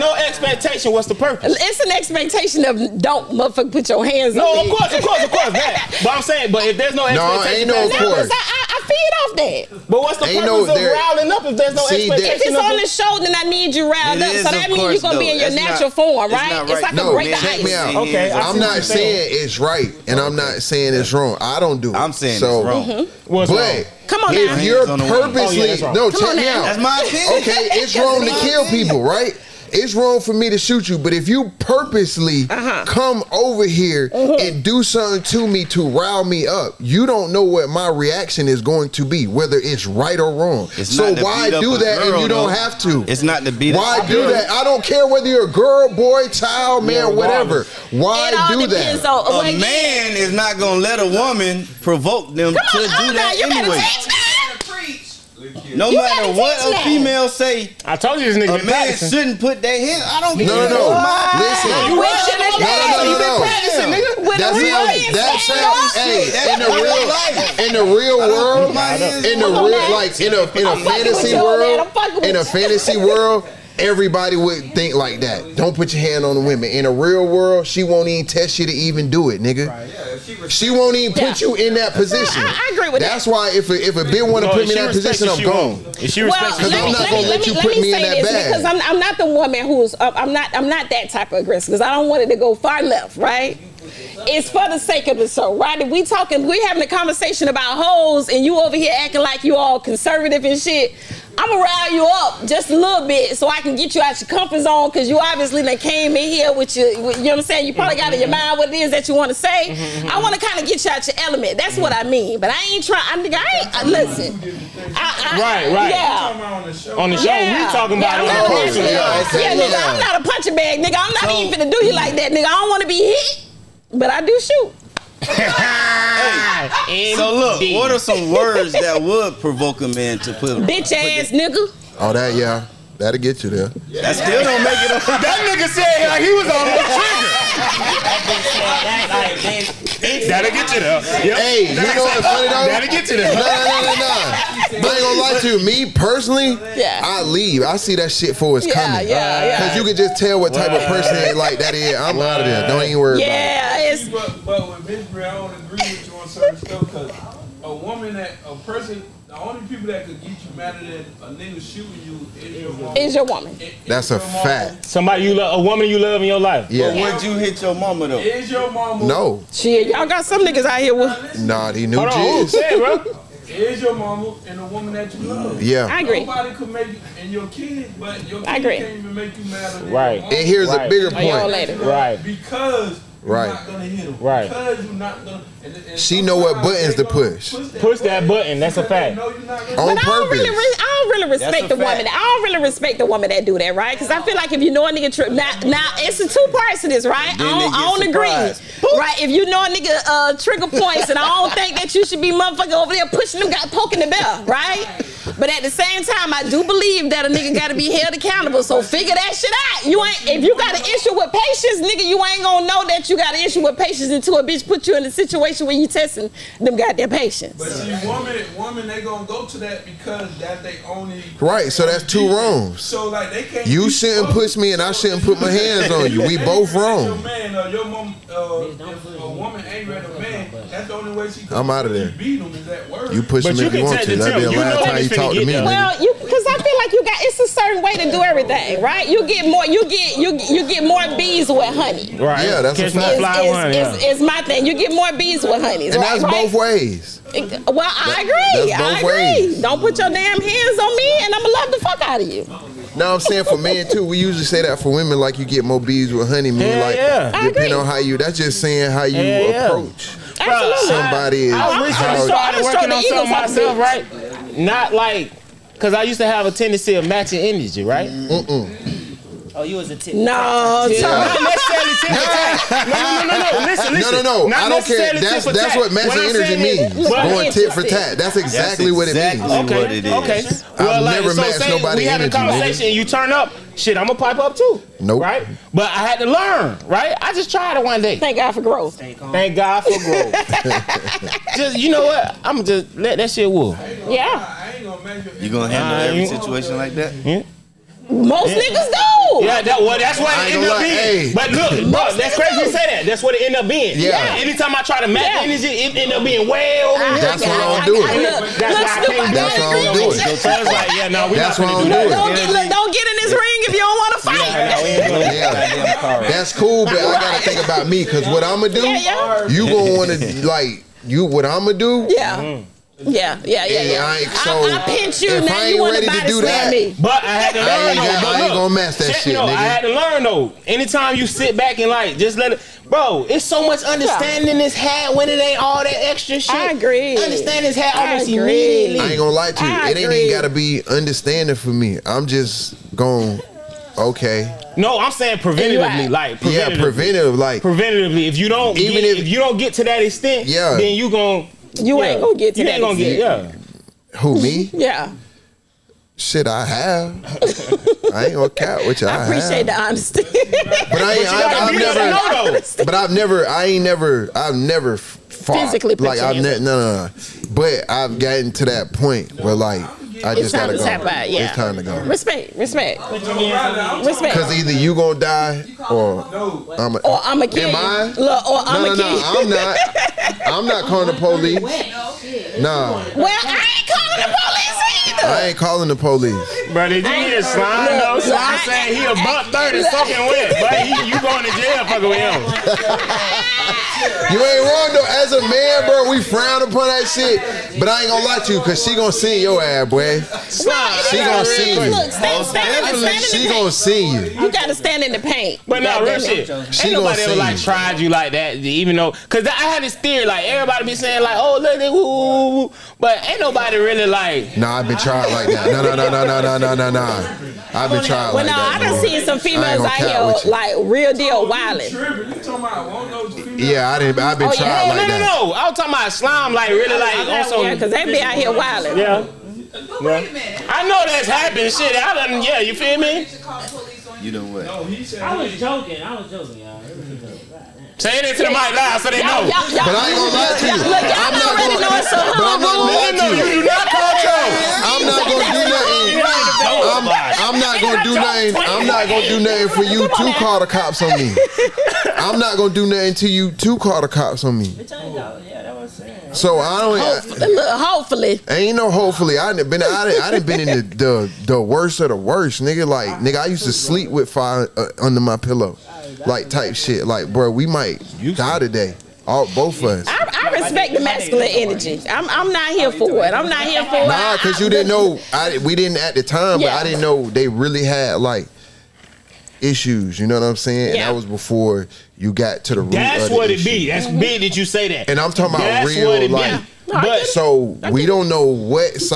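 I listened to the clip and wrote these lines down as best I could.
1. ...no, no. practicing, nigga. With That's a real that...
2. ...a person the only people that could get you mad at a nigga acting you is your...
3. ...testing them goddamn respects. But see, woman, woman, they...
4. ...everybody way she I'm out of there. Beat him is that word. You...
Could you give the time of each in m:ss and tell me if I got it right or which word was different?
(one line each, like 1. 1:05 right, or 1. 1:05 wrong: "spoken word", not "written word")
1. 1:03 right
2. 2:38 wrong: "shooting", not "acting"
3. 3:35 wrong: "patients", not "respects"
4. 3:49 wrong: "ready", not "everybody".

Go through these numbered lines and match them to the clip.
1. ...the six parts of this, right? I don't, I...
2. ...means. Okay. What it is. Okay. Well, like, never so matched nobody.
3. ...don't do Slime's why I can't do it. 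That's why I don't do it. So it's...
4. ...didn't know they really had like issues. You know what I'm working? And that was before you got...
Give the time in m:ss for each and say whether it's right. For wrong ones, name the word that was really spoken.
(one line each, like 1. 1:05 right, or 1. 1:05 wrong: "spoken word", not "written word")
1. 3:16 wrong: "two", not "six"
2. 4:39 right
3. 5:07 wrong: "That", not "Slime"
4. 7:56 wrong: "saying", not "working".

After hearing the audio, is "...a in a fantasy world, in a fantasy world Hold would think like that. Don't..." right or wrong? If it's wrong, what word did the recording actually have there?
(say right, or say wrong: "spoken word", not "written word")
wrong: "Everybody", not "Hold".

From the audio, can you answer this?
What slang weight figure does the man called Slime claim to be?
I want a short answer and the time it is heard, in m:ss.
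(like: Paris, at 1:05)
a buck thirty, at 6:29.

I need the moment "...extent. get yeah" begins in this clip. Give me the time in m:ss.
5:52.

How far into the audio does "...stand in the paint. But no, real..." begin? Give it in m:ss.
6:44.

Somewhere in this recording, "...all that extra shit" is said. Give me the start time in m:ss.
5:35.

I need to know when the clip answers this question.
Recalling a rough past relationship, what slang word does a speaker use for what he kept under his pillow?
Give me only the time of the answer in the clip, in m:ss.
7:44.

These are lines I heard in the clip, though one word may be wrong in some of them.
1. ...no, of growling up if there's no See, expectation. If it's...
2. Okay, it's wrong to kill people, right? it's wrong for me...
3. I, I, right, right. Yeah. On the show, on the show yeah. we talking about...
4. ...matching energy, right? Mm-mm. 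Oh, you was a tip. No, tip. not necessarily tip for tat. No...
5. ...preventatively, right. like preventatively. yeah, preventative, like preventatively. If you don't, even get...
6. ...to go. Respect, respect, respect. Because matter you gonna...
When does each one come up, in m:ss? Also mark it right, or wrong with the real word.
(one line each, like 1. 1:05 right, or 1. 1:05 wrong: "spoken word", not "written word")
1. 0:10 right
2. 0:27 right
3. 1:54 right
4. 4:27 right
5. 5:45 right
6. 6:11 wrong: "either", not "matter".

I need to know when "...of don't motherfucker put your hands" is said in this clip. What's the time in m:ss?
0:02.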